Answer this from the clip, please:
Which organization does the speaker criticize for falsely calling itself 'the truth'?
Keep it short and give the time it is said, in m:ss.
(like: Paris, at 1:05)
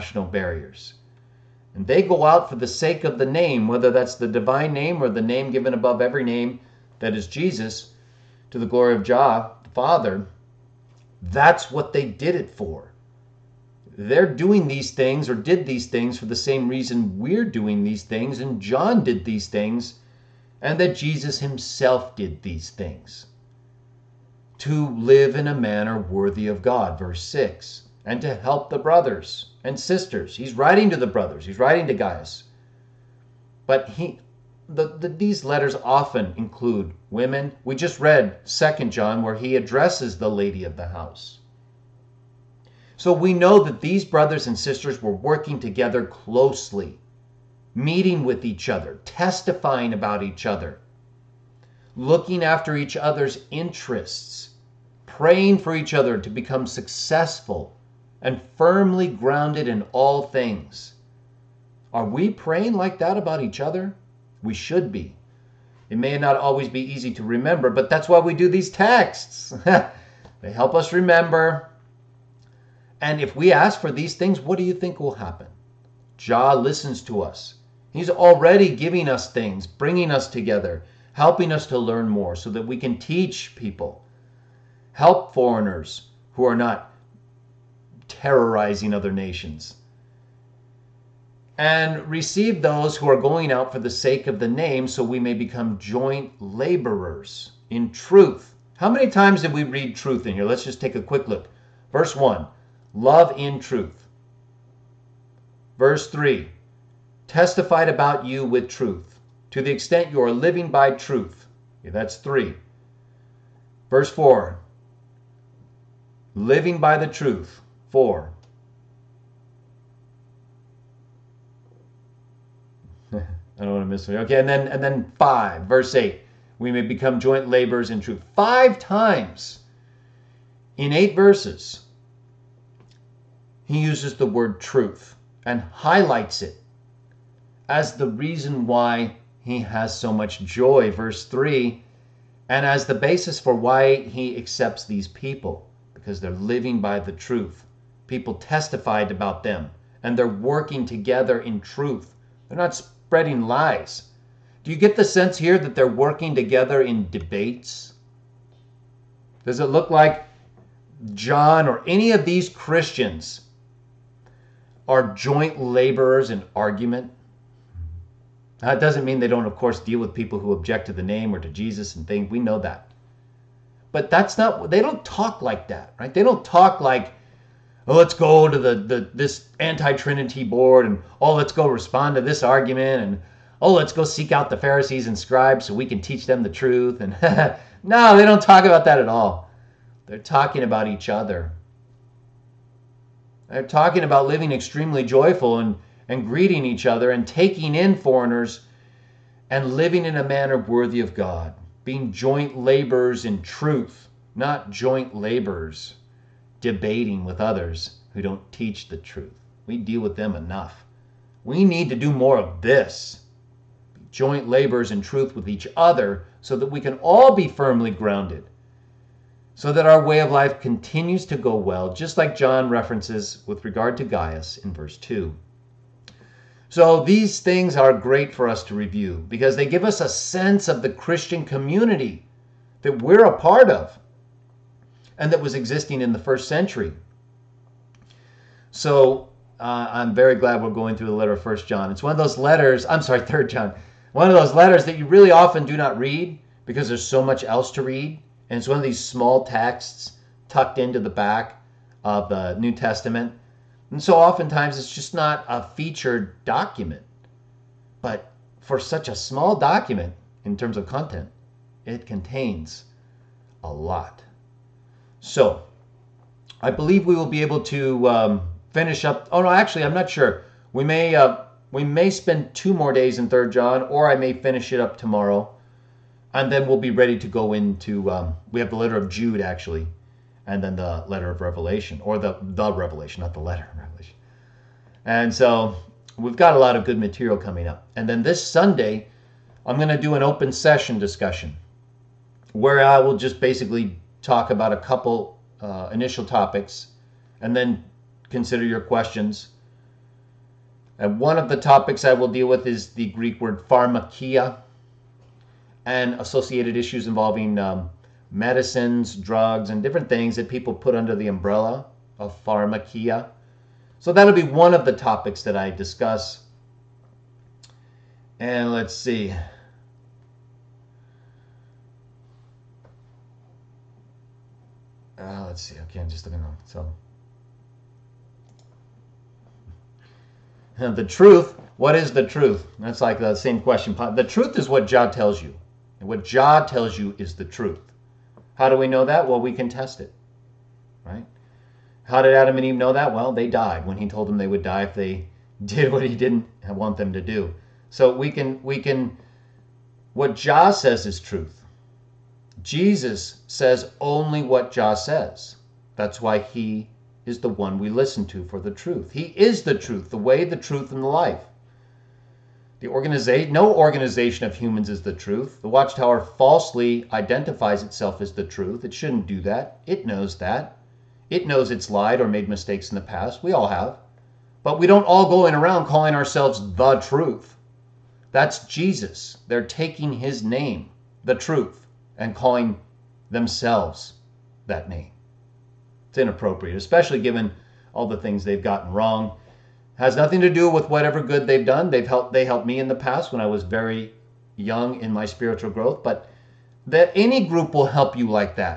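The Watchtower, at 6:05.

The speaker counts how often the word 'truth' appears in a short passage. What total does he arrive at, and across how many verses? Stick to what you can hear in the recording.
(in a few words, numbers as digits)
5 times in 8 verses.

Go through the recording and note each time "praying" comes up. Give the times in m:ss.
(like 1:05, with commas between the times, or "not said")
0:55, 1:02.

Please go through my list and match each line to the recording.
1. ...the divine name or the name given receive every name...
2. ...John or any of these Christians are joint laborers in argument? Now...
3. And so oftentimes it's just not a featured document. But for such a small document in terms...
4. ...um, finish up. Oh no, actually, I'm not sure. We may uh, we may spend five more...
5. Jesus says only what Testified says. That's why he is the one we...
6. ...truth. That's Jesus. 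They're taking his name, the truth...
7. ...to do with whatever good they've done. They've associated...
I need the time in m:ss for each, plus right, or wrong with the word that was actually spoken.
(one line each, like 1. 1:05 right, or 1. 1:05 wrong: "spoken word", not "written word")
1. 0:04 wrong: "above", not "receive"
2. 2:41 right
3. 4:13 right
4. 4:28 wrong: "two", not "five"
5. 5:52 wrong: "Jah", not "Testified"
6. 6:16 right
7. 6:30 wrong: "helped", not "associated".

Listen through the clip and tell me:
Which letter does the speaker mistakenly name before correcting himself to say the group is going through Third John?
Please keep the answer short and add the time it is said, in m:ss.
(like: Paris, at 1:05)
First John, at 4:01.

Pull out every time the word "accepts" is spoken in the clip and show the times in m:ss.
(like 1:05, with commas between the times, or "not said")
2:24.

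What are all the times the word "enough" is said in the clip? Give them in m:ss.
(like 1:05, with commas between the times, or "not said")
3:30.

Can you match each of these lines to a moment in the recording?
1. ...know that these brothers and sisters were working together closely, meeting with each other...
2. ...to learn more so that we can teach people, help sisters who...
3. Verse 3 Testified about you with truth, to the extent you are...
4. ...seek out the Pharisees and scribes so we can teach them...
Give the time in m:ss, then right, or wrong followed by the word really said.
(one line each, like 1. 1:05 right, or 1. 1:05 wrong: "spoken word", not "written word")
1. 0:43 right
2. 1:21 wrong: "foreigners", not "sisters"
3. 1:45 right
4. 3:04 right.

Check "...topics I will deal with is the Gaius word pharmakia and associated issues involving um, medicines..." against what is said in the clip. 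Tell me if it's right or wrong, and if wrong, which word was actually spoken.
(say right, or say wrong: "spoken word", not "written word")
wrong: "Greek", not "Gaius".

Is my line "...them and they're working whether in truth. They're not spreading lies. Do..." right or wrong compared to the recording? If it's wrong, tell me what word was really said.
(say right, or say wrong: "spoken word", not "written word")
wrong: "together", not "whether".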